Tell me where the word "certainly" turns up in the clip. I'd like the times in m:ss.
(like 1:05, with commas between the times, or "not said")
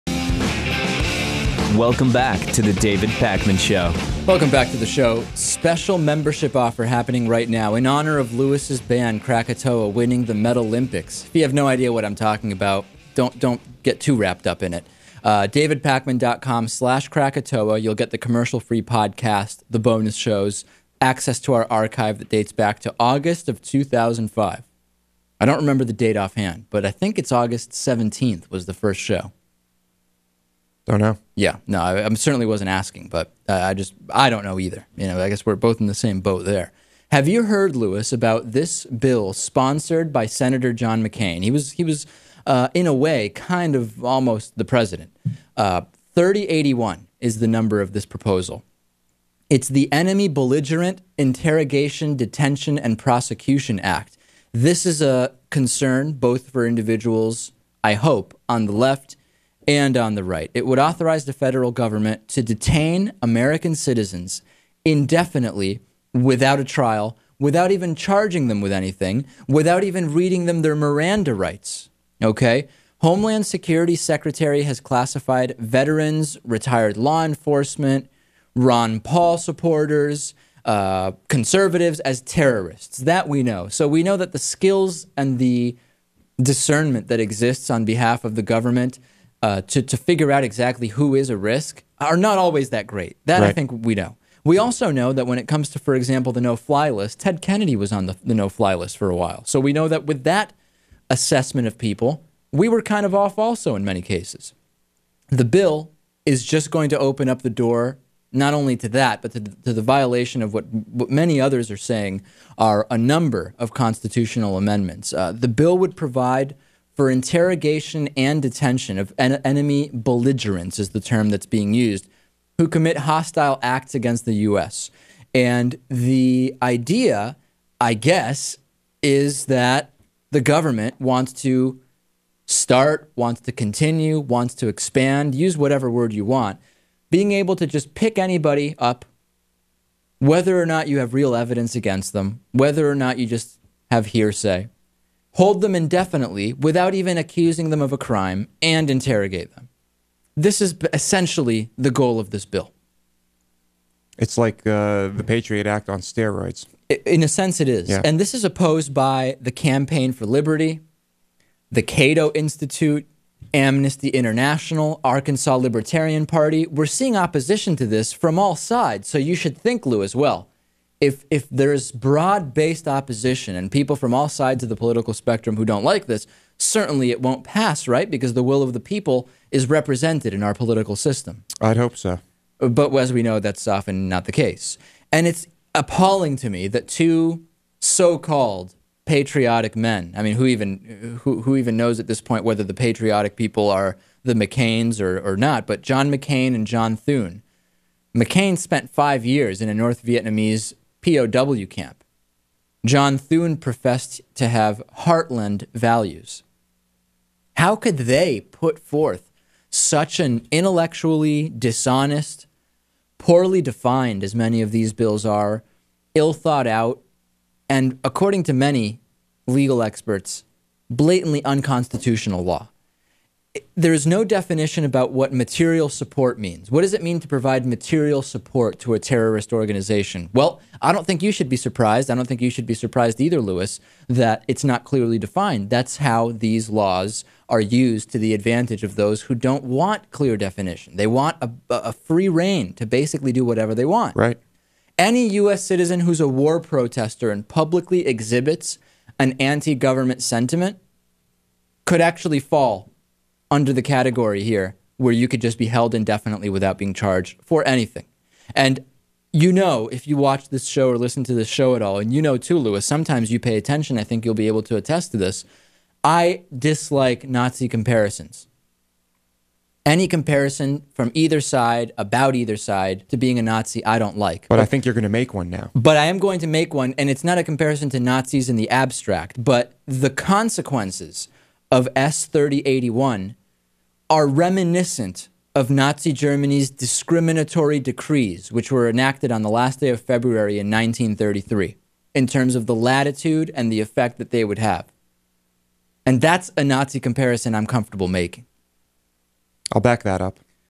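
0:32, 2:56.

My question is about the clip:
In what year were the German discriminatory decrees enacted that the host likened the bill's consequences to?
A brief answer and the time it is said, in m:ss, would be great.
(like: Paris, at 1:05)
1933, at 4:50.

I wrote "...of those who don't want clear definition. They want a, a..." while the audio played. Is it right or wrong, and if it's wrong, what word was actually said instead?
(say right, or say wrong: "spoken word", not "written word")
right.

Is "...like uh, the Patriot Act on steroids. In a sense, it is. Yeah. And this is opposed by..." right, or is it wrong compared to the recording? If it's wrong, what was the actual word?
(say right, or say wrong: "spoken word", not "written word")
right.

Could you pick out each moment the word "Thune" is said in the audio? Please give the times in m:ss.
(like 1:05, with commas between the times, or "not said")
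3:16, 3:23.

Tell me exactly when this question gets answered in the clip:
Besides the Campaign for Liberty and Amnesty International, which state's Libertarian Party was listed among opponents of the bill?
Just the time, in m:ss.
2:45.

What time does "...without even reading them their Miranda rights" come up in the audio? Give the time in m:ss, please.
1:09.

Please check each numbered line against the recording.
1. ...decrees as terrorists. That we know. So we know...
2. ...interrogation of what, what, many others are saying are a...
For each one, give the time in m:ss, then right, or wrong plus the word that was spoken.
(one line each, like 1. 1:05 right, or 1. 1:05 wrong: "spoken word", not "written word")
1. 1:21 wrong: "conservatives", not "decrees"
2. 1:49 wrong: "violation", not "interrogation".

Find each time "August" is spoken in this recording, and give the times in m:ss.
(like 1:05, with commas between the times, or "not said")
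0:22, 0:27.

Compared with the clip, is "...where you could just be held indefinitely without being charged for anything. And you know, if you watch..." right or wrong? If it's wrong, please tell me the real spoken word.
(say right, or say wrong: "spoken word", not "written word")
right.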